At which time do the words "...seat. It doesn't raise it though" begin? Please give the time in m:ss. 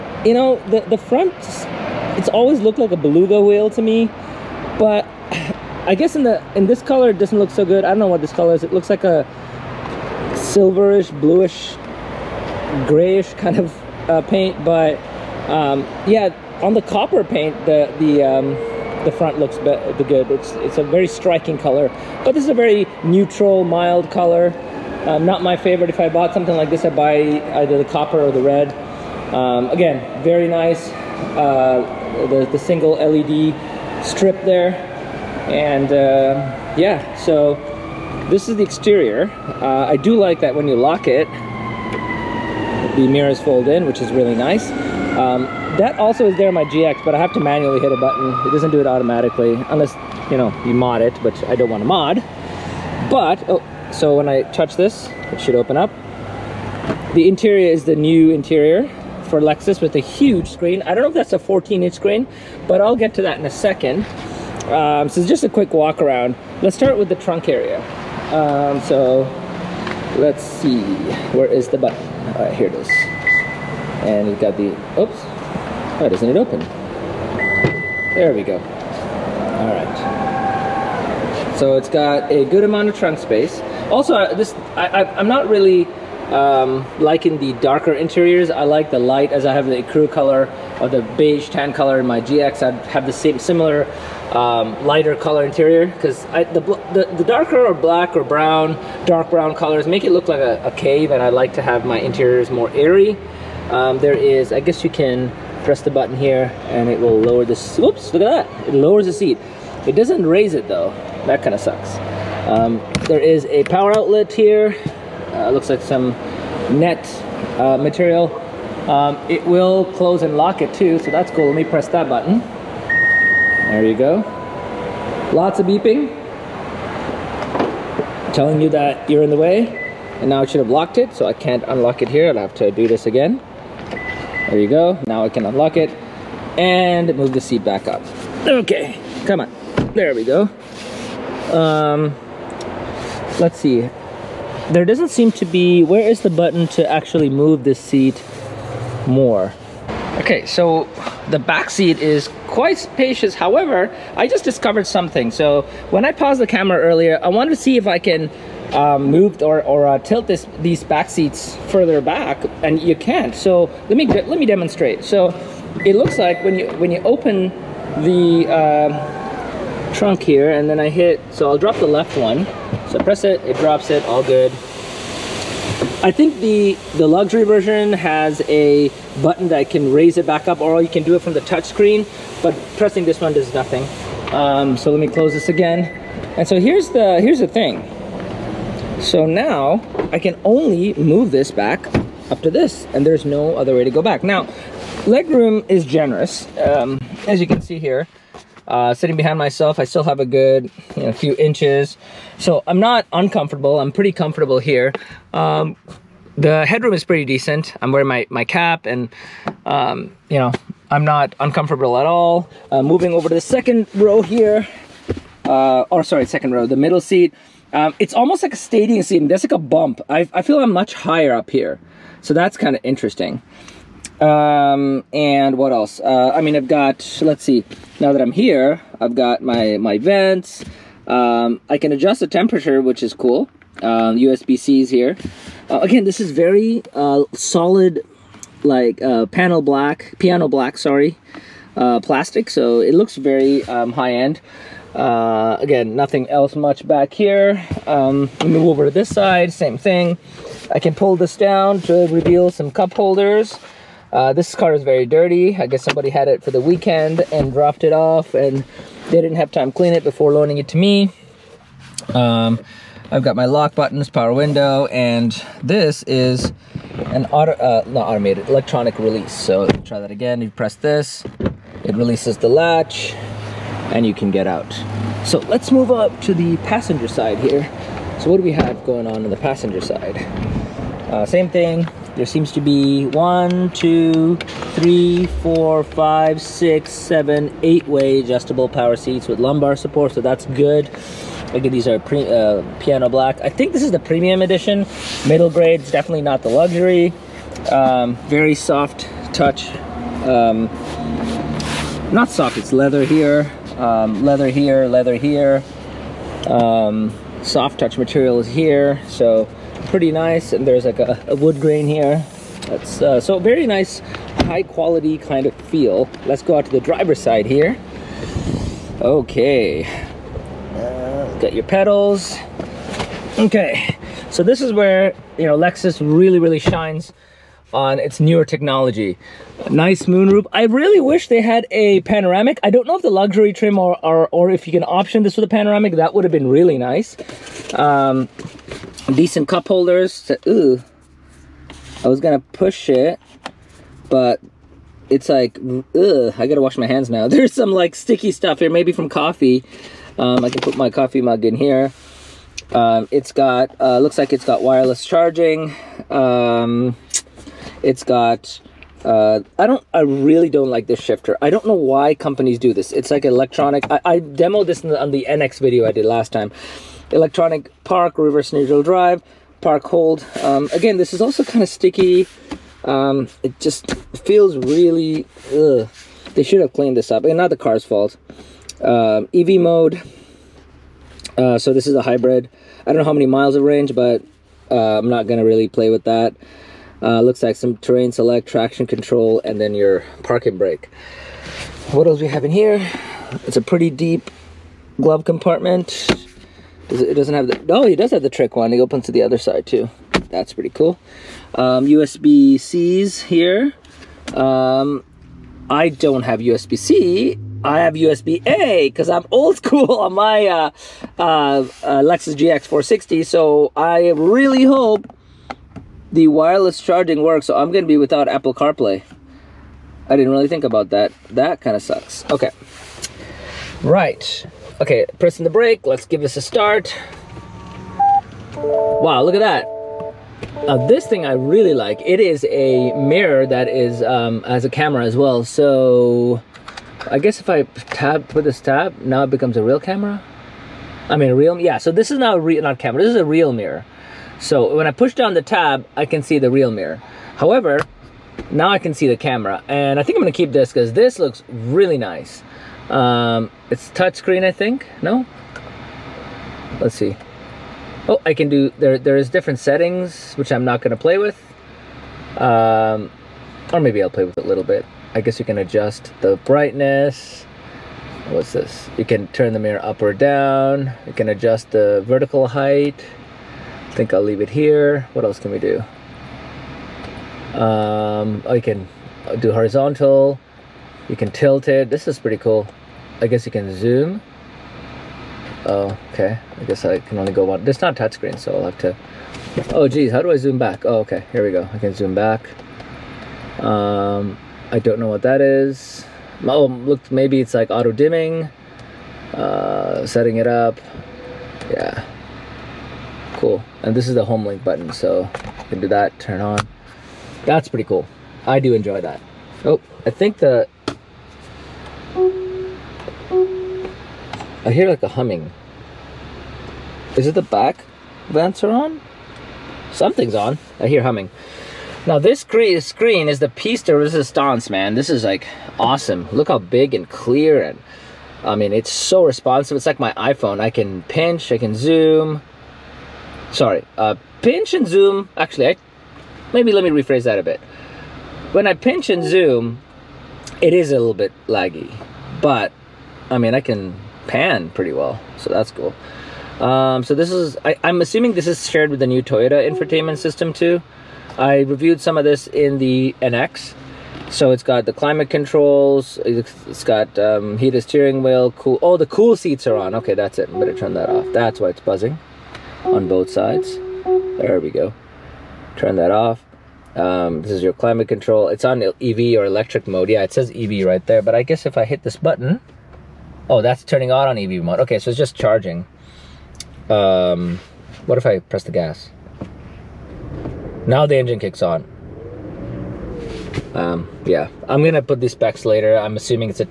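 1:49.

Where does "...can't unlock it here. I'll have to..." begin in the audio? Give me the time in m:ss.
2:11.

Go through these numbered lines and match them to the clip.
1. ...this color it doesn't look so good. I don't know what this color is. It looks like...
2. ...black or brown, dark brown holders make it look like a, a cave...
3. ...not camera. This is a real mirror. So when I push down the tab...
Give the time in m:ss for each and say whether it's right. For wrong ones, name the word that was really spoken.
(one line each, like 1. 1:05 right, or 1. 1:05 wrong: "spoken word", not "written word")
1. 0:06 right
2. 1:37 wrong: "colors", not "holders"
3. 7:22 right.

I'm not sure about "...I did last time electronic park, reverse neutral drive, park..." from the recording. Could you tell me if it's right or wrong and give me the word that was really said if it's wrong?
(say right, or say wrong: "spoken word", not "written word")
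right.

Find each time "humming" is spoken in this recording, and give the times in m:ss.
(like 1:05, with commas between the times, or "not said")
8:35, 8:41.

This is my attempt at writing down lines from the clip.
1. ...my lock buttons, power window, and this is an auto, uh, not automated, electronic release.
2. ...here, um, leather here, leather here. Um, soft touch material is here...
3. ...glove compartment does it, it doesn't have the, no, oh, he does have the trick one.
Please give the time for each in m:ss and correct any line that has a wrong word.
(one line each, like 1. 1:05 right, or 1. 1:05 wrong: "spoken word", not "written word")
1. 4:23 right
2. 5:03 right
3. 6:34 right.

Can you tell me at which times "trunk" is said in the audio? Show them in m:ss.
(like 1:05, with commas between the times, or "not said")
1:07, 1:22, 2:49.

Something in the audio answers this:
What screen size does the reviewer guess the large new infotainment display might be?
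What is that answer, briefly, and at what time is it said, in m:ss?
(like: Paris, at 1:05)
14-inch, at 1:01.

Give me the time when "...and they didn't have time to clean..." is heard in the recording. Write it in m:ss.
4:18.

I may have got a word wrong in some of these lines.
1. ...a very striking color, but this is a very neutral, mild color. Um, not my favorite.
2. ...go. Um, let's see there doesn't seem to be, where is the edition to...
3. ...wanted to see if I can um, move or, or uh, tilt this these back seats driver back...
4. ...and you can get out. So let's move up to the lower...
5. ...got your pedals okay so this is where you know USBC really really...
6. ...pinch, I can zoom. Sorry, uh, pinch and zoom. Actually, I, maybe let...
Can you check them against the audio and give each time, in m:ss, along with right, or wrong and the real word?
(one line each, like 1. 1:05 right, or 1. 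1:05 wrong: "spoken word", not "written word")
1. 0:20 right
2. 2:20 wrong: "button", not "edition"
3. 2:37 wrong: "further", not "driver"
4. 4:33 wrong: "passenger", not "lower"
5. 5:21 wrong: "Lexus", not "USBC"
6. 8:51 right.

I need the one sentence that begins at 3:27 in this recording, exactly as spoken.
I'm wearing my, my cap and, um, you know, I'm not uncomfortable at all.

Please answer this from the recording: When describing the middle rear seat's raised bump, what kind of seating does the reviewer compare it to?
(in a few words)
Stadium seat.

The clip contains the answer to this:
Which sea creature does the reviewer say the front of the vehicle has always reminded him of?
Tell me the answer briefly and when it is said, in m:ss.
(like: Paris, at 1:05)
Beluga whale, at 0:02.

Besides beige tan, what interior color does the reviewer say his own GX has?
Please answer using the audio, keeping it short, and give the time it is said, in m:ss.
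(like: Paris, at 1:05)
Crew, at 1:29.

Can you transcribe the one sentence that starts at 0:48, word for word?
It doesn't do it automatically, unless, you know, you mod it, which I don't want to mod.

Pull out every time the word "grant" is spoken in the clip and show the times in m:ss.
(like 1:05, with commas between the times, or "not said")
not said.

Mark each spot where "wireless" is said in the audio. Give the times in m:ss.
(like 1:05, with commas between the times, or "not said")
5:54, 6:56.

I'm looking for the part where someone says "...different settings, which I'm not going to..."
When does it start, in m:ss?
7:39.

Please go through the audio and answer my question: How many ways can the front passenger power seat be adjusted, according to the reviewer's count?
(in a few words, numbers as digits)
8.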